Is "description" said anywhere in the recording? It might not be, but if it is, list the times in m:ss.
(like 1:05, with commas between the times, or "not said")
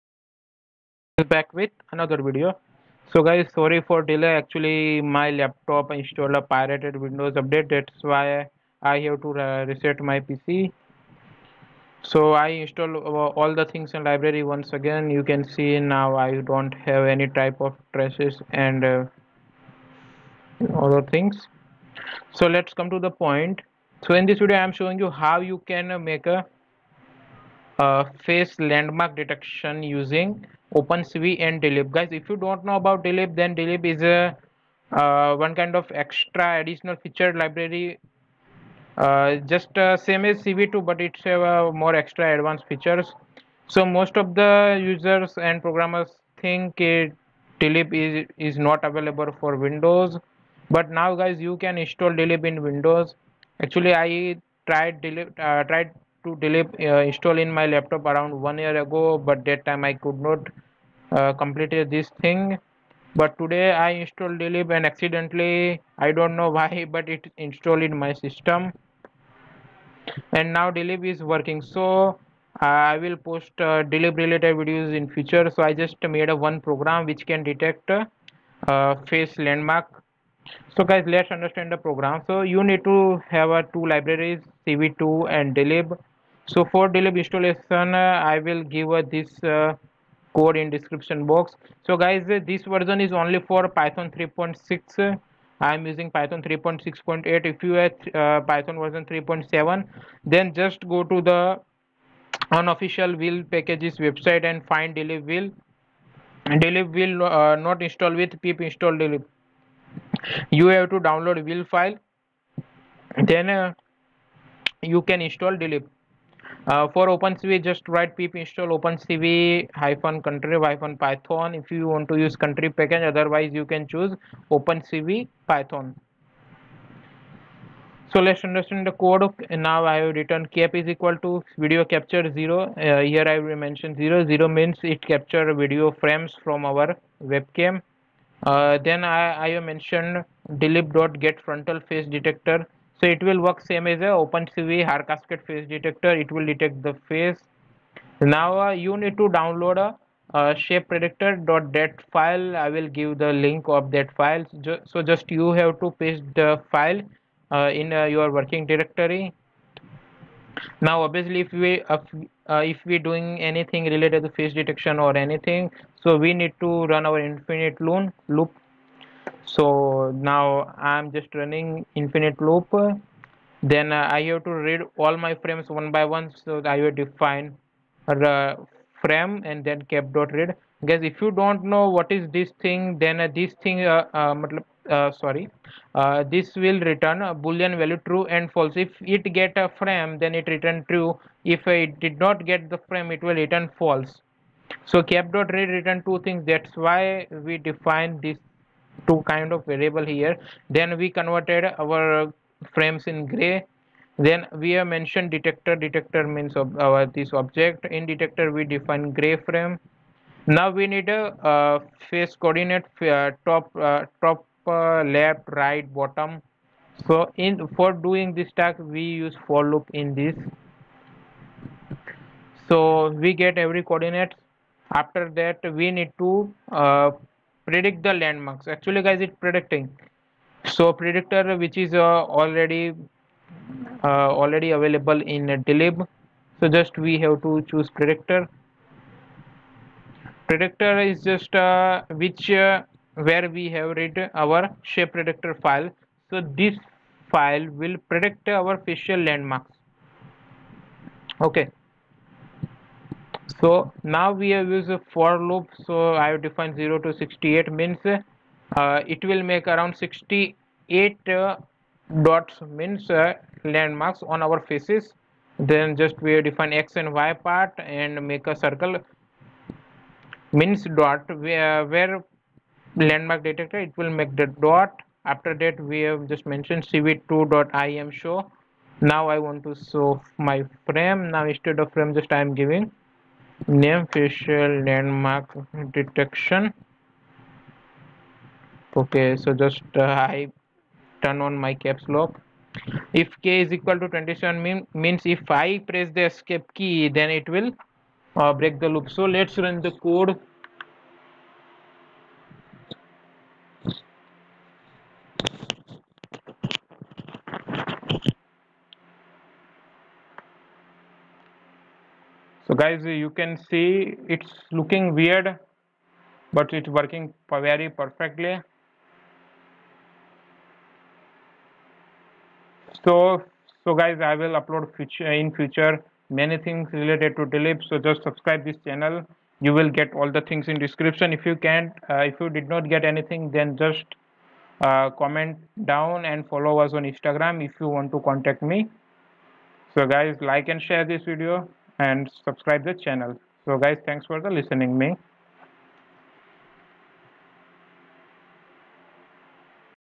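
1:30, 5:30.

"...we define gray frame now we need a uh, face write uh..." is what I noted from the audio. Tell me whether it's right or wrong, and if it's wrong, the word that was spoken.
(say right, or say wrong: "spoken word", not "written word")
wrong: "coordinate", not "write".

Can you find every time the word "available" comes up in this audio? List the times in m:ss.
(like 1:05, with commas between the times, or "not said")
0:48, 3:54.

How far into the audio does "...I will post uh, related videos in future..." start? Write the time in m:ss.
1:12.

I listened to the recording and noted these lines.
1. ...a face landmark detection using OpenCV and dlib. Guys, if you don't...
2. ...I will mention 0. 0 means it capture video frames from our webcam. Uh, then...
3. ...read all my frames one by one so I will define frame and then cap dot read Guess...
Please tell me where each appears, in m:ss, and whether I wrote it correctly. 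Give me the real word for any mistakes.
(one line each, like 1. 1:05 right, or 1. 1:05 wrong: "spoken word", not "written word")
1. 0:26 right
2. 2:13 right
3. 2:54 right.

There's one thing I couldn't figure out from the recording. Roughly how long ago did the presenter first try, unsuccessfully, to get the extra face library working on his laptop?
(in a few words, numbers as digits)
One year ago.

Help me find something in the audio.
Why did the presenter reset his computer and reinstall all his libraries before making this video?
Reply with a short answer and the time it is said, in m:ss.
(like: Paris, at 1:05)
A pirated Windows update, at 0:06.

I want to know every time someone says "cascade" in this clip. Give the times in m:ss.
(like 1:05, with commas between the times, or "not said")
2:25.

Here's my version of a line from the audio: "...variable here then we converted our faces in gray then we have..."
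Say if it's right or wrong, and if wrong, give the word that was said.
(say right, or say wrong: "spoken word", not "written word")
wrong: "frames", not "faces".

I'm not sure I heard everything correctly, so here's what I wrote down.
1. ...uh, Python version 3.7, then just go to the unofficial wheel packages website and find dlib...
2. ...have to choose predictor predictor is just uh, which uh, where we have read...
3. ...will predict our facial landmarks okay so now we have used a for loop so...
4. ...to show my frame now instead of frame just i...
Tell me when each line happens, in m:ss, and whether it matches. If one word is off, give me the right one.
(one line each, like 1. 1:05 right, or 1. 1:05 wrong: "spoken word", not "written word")
1. 1:38 right
2. 3:57 right
3. 4:07 right
4. 4:39 right.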